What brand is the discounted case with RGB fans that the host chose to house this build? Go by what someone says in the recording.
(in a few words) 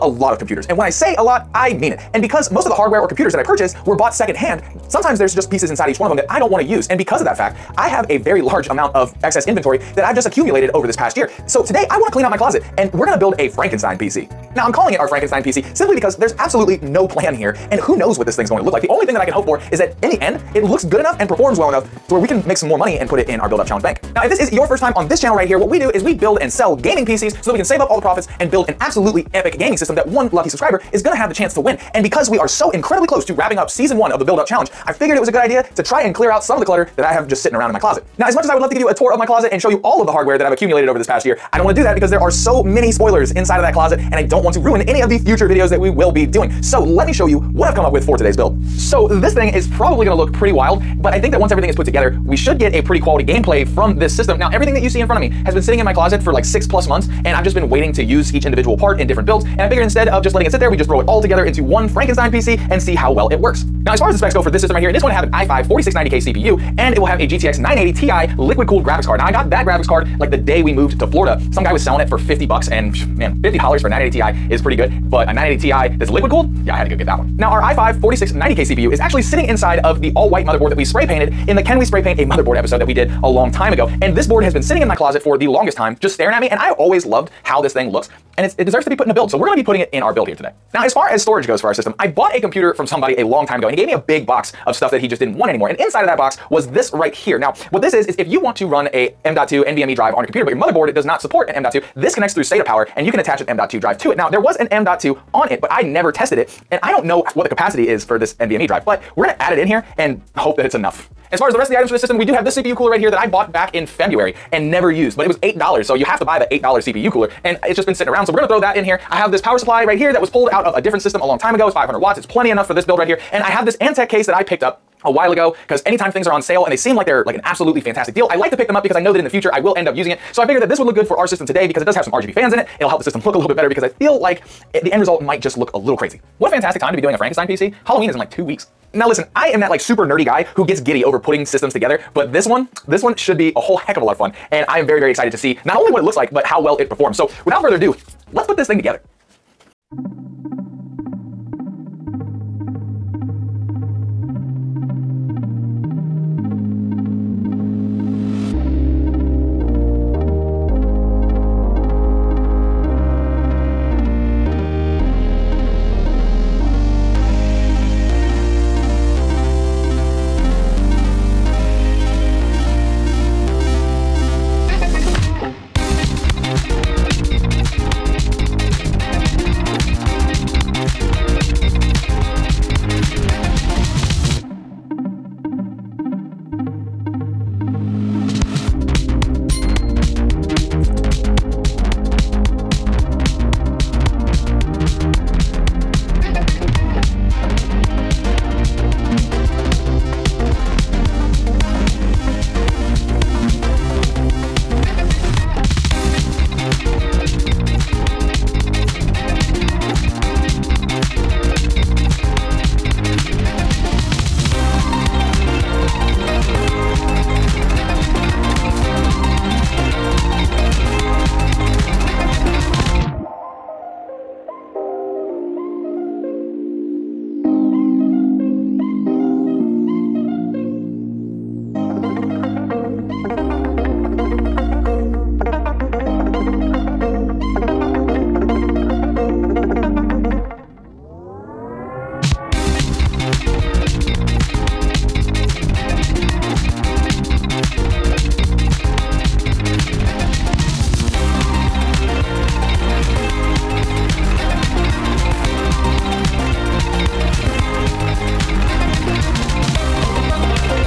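Antec.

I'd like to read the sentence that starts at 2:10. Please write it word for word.
So I figured that this would look good for our system today because it does have some RGB fans in it.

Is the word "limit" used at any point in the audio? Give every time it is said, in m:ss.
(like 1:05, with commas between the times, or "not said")
not said.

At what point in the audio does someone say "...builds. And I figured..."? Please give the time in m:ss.
0:59.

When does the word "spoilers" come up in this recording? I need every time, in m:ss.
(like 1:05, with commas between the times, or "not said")
0:42.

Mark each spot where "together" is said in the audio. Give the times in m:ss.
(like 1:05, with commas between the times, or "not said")
0:51, 1:01, 2:21, 2:28.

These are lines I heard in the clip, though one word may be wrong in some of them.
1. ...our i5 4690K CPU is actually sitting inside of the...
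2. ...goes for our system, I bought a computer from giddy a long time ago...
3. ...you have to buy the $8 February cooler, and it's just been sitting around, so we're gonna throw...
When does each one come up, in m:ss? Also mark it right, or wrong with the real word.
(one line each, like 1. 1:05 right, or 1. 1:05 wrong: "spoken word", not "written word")
1. 1:17 right
2. 1:31 wrong: "somebody", not "giddy"
3. 1:55 wrong: "CPU", not "February".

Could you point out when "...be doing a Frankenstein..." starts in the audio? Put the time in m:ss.
2:16.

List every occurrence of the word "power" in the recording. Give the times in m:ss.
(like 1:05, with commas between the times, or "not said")
1:42, 1:59.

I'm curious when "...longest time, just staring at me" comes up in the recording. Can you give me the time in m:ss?
1:25.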